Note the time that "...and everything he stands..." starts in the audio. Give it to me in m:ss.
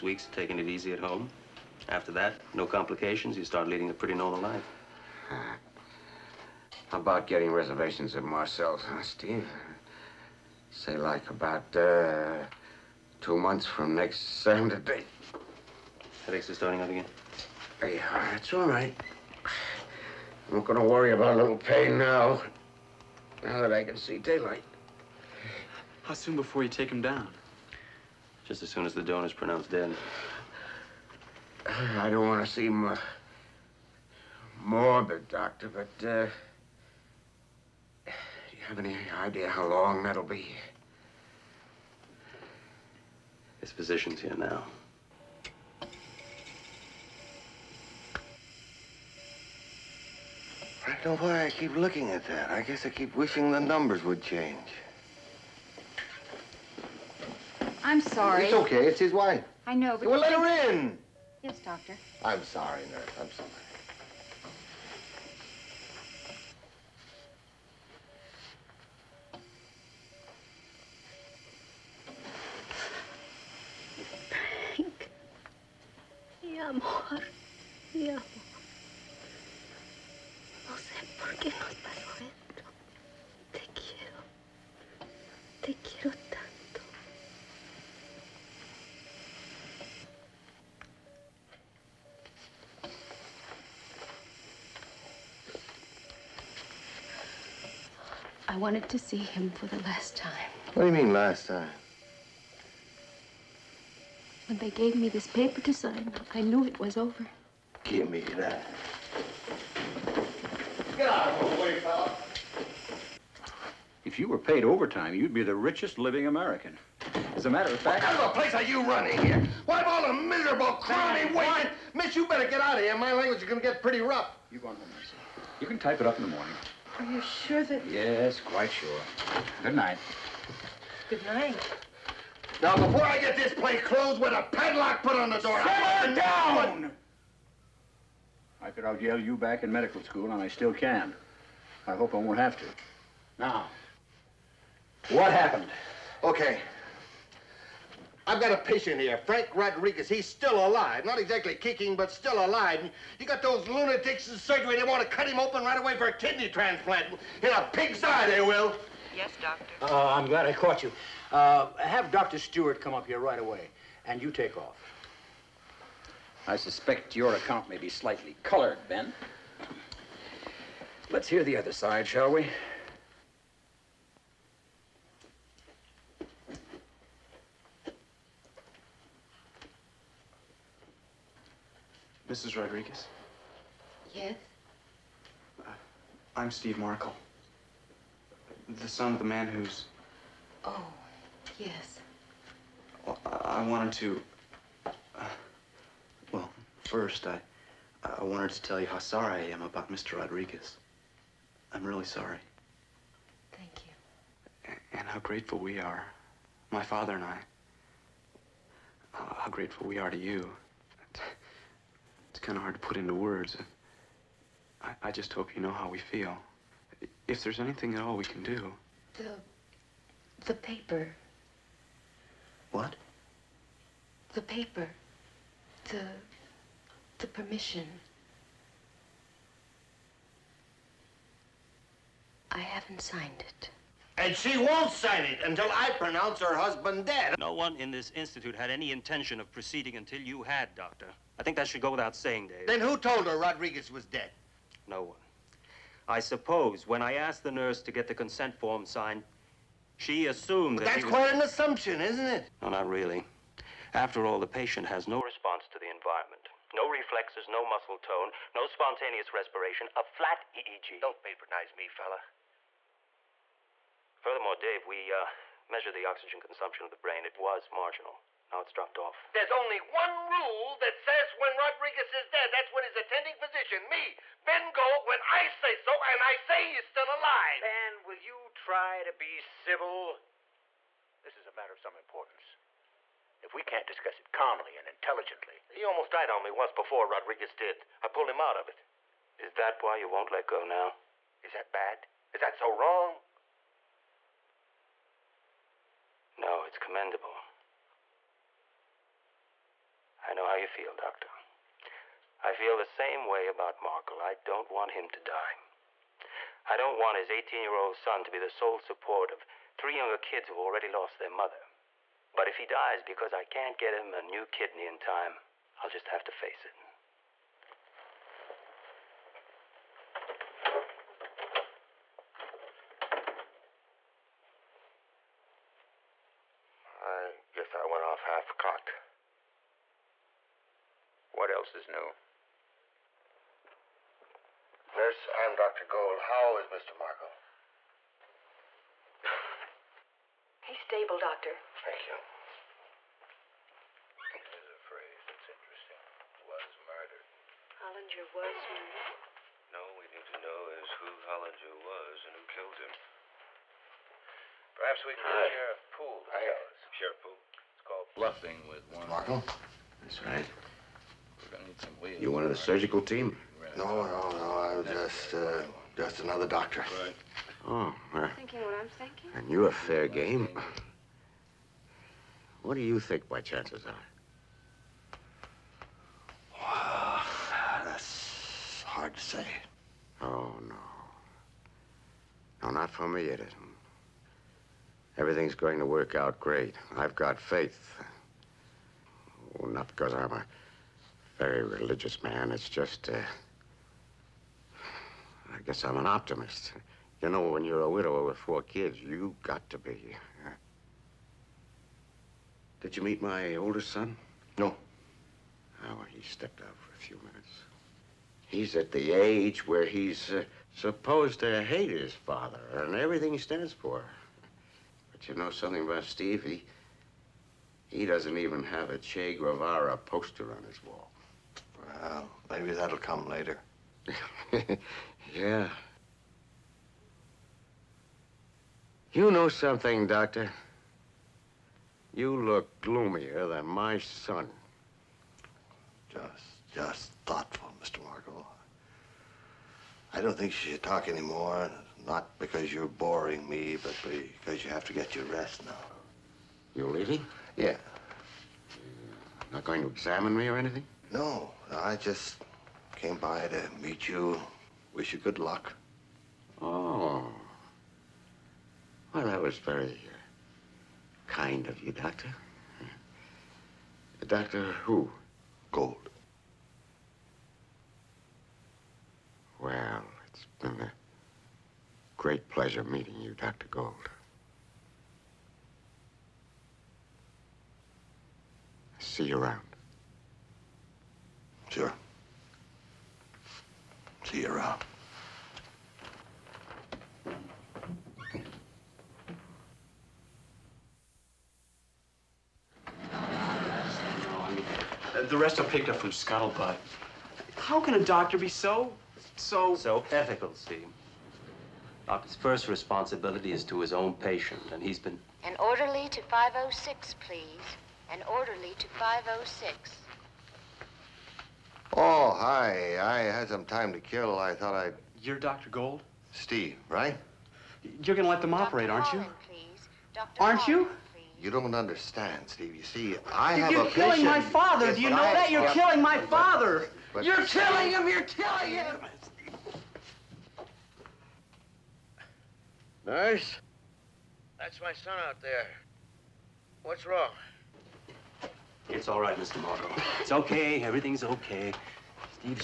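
6:52.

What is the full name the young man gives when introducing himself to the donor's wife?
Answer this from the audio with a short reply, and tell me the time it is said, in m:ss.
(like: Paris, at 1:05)
Steve Markle, at 3:06.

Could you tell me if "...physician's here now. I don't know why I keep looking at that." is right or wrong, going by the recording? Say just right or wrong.
right.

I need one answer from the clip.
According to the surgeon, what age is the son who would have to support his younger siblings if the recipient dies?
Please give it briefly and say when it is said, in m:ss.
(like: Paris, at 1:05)
18, at 5:07.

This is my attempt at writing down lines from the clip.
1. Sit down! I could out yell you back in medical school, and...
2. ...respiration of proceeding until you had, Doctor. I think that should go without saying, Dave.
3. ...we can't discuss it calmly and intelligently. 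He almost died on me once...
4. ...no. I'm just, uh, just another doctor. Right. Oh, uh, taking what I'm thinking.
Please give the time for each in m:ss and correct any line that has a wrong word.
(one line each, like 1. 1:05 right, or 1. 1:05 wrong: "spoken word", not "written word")
1. 2:15 right
2. 3:58 wrong: "intention", not "respiration"
3. 4:43 right
4. 6:04 wrong: "thinking", not "taking".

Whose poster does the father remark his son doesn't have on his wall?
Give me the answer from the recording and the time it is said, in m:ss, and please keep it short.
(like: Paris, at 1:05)
Che Guevara, at 6:58.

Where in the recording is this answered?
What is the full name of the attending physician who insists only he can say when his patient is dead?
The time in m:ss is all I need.
4:34.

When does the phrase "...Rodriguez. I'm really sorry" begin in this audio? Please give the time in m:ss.
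3:20.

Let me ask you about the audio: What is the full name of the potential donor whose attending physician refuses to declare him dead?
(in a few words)
Frank Rodriguez.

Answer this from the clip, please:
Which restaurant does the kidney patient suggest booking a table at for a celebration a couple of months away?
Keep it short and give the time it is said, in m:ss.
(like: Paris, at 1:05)
Marcel's, at 0:08.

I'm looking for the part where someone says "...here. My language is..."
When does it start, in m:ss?
2:02.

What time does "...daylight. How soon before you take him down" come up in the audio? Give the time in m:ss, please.
0:24.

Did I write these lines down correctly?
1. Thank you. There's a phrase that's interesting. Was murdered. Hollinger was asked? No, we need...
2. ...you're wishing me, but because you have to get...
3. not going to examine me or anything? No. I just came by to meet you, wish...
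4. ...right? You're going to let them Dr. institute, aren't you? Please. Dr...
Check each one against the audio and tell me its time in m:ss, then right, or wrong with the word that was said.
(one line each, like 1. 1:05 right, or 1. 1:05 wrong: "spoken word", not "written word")
1. 5:41 wrong: "murdered", not "asked"
2. 7:22 wrong: "boring", not "wishing"
3. 7:29 right
4. 8:36 wrong: "operate", not "institute".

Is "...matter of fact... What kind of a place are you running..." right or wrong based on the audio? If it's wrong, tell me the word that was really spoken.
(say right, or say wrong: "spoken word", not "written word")
right.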